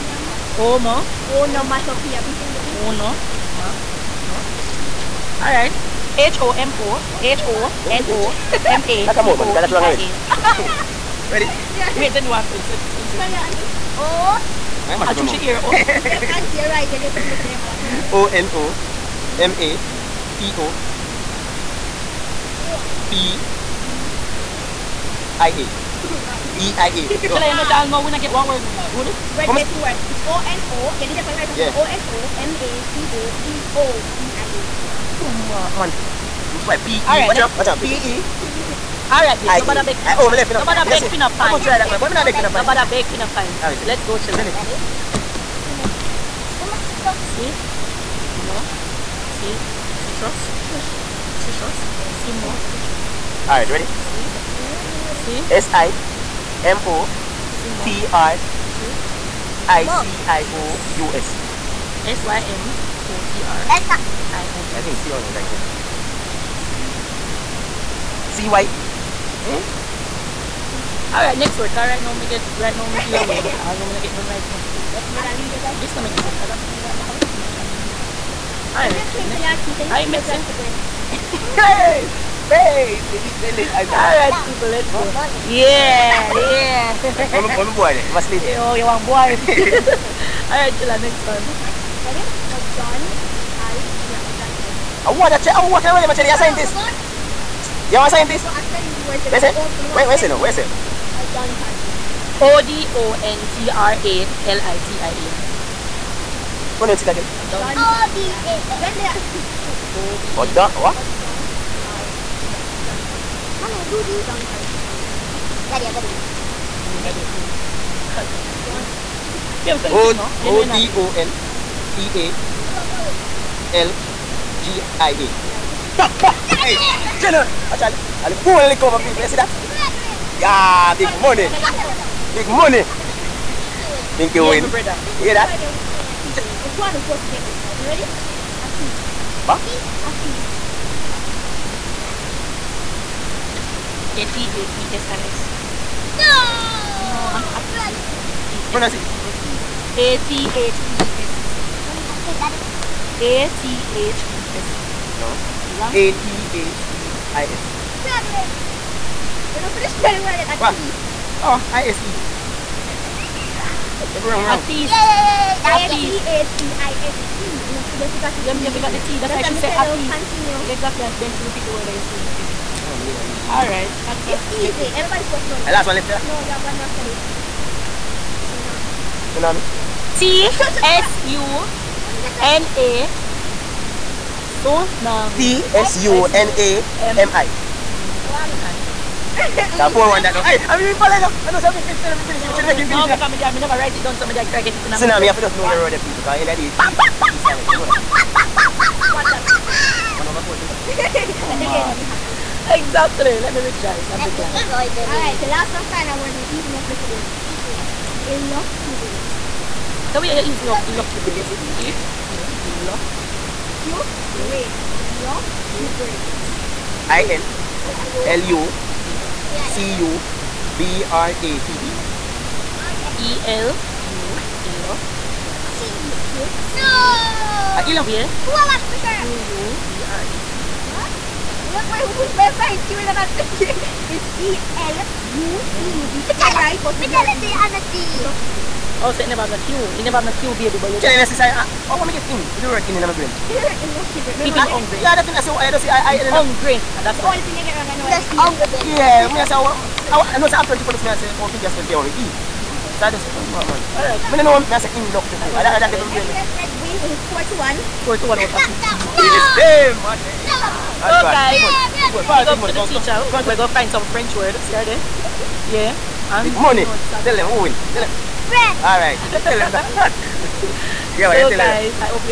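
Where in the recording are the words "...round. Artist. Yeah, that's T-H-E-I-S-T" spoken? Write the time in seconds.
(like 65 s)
164 s.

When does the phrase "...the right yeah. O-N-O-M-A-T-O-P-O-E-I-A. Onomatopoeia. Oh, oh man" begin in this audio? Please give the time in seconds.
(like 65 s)
31 s.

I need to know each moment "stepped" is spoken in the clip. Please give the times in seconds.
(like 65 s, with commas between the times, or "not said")
not said.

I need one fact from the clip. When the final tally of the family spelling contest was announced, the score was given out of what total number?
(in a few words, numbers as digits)
15.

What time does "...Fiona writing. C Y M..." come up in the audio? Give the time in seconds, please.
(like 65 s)
64 s.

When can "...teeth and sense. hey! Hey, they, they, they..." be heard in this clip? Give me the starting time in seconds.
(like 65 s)
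79 s.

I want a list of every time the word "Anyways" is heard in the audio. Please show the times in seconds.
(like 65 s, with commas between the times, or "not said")
256 s.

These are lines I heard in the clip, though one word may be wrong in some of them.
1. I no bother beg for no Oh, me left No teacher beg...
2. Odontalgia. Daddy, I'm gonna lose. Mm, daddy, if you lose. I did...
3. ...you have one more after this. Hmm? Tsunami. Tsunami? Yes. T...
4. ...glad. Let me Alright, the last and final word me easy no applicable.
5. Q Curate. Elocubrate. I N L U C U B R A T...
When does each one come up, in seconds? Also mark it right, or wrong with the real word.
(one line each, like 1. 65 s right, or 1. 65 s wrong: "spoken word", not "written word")
1. 39 s wrong: "bother", not "teacher"
2. 114 s right
3. 176 s right
4. 204 s right
5. 213 s right.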